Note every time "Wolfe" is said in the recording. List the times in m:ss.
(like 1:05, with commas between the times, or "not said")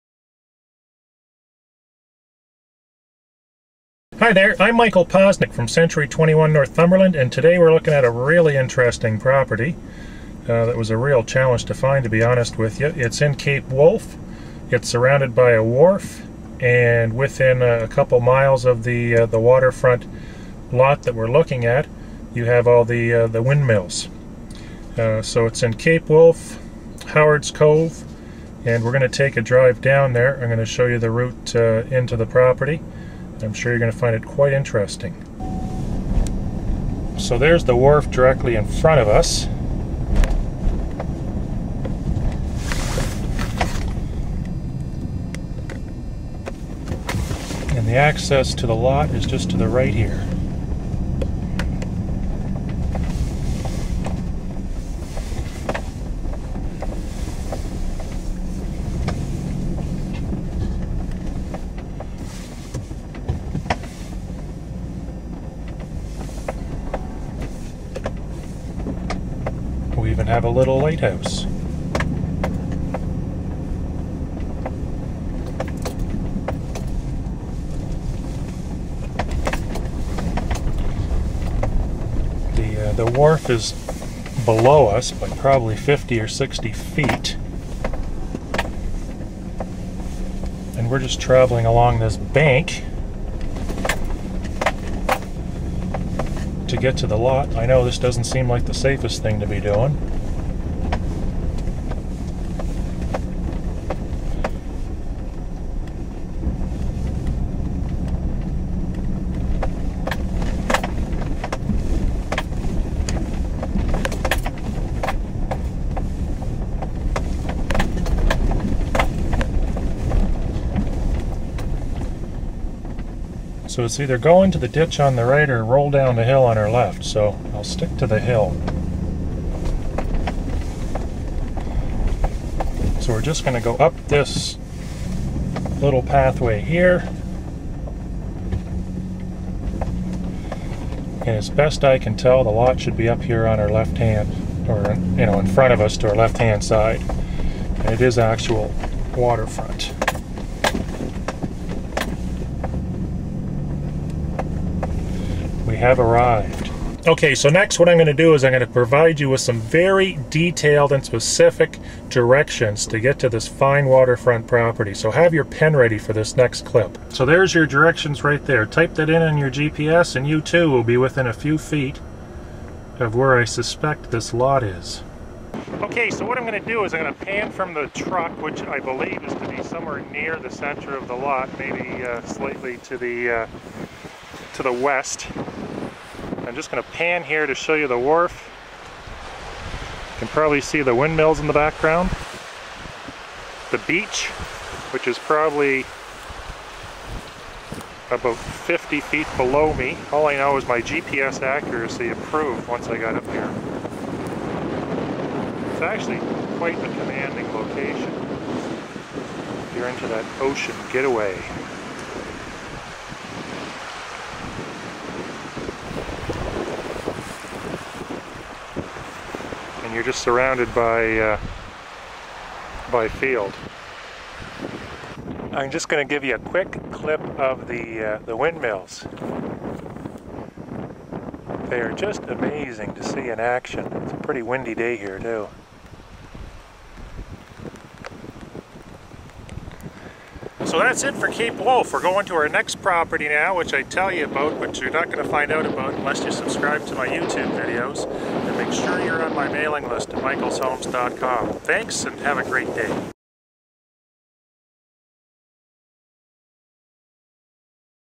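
0:13, 0:26, 4:01.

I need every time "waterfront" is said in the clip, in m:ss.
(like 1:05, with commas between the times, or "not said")
0:19, 2:29, 2:43.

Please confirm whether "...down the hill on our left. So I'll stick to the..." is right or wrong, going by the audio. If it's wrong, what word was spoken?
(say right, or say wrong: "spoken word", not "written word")
right.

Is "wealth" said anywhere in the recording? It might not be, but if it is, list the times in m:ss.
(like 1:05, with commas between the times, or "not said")
not said.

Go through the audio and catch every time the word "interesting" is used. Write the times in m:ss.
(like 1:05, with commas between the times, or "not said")
0:08, 0:34.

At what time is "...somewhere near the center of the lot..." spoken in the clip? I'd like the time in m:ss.
2:59.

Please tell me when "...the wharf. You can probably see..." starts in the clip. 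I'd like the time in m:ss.
3:07.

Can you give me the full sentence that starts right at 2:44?
So have your pen ready for this next clip.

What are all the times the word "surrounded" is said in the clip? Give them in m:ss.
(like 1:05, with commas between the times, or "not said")
0:14, 3:40.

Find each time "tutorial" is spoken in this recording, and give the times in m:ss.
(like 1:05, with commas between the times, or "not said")
not said.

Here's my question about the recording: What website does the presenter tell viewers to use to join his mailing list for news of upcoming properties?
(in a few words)
michaelshomes.com.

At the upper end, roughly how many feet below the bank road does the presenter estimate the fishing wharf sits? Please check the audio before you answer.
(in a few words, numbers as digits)
60 feet.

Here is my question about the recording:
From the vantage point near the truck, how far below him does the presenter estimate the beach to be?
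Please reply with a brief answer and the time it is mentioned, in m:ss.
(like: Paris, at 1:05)
50 feet, at 3:18.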